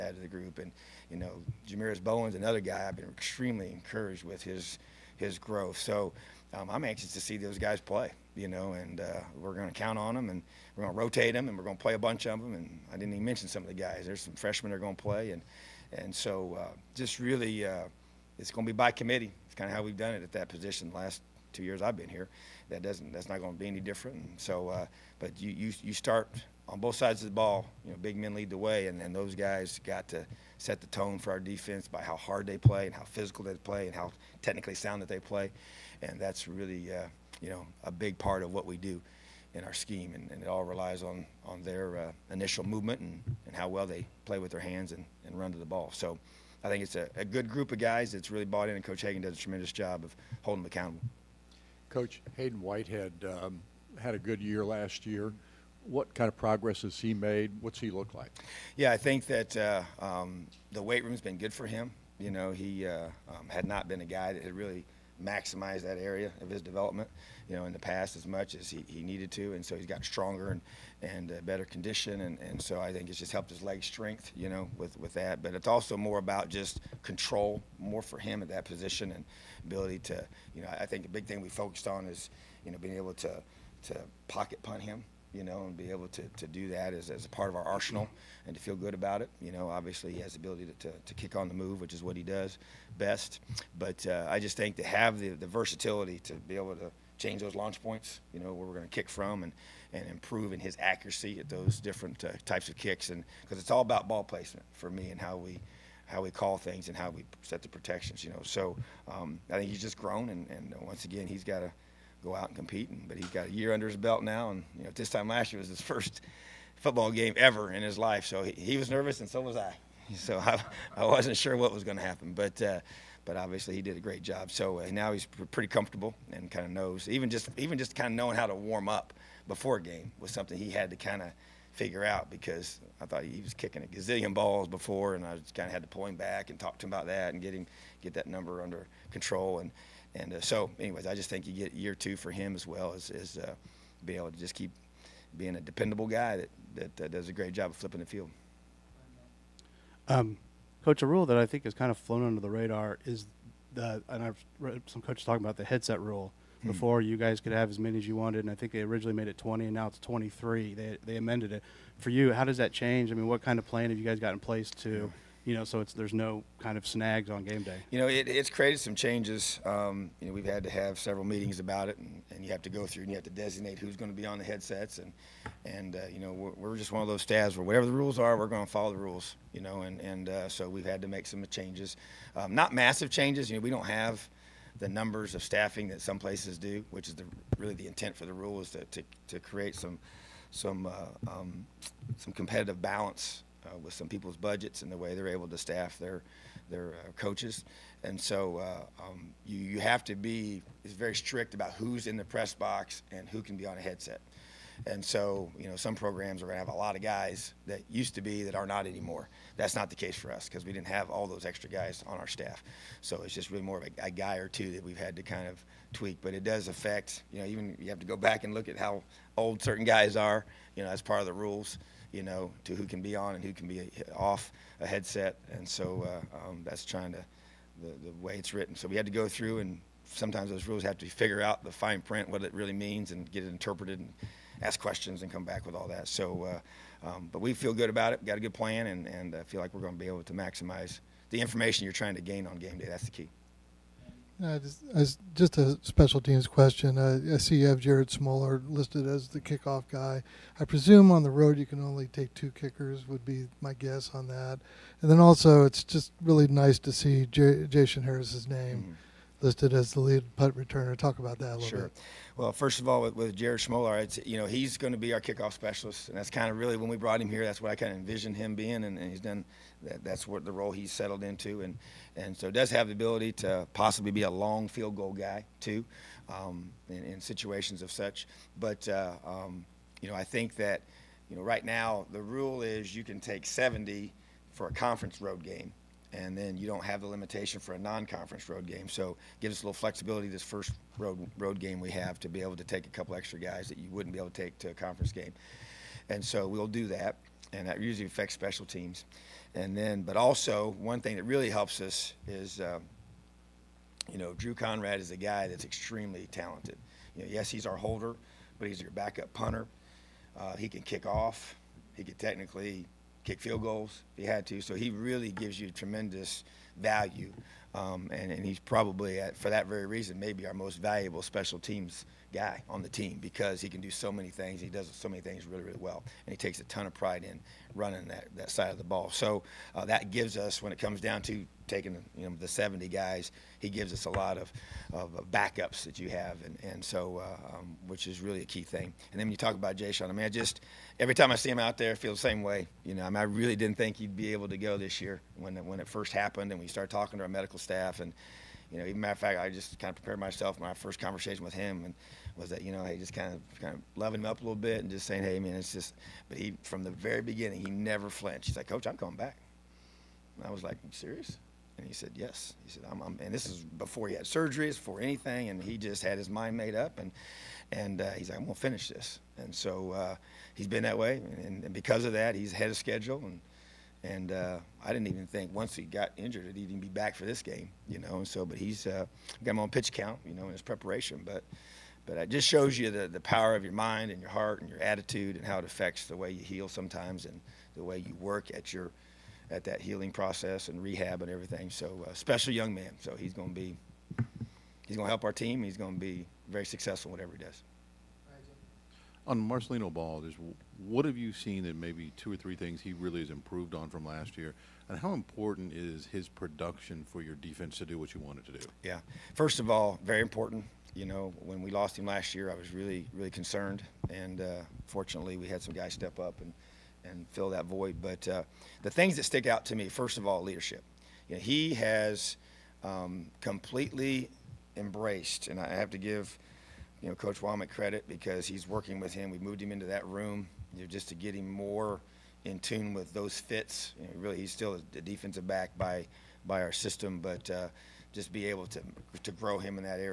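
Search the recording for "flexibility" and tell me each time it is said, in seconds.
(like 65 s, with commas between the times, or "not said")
289 s.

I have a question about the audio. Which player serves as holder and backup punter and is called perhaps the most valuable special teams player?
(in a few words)
Drew Conrad.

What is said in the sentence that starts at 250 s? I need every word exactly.
I presume on the road you can only take two kickers, would be my guess on that.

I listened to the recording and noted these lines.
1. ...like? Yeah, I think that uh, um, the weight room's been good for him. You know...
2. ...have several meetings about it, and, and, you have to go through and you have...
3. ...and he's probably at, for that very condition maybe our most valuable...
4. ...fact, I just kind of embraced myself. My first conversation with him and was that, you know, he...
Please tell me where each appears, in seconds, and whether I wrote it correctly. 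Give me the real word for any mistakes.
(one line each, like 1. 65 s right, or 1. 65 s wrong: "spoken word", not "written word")
1. 58 s right
2. 170 s right
3. 318 s wrong: "reason", not "condition"
4. 349 s wrong: "prepared", not "embraced".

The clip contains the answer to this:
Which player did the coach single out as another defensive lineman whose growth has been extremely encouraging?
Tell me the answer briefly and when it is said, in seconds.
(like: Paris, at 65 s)
Jamiris Bowen, at 1 s.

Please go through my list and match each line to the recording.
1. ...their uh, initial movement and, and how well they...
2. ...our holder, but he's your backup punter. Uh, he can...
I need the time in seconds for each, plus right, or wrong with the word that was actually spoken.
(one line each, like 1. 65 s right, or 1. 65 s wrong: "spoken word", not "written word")
1. 41 s right
2. 307 s right.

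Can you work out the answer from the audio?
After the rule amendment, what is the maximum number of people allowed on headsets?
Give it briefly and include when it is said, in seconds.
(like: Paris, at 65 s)
23, at 159 s.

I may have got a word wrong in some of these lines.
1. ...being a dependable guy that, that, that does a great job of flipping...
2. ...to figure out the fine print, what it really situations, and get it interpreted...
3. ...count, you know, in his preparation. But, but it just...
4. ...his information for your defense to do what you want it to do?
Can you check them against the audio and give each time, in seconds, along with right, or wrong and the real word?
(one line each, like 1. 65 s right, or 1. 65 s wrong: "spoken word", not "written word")
1. 145 s right
2. 230 s wrong: "means", not "situations"
3. 379 s right
4. 406 s wrong: "production", not "information".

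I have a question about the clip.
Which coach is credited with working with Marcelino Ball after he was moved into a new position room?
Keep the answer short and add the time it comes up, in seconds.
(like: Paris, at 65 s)
Coach Wommack, at 427 s.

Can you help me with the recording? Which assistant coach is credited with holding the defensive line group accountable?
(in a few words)
Coach Hagen.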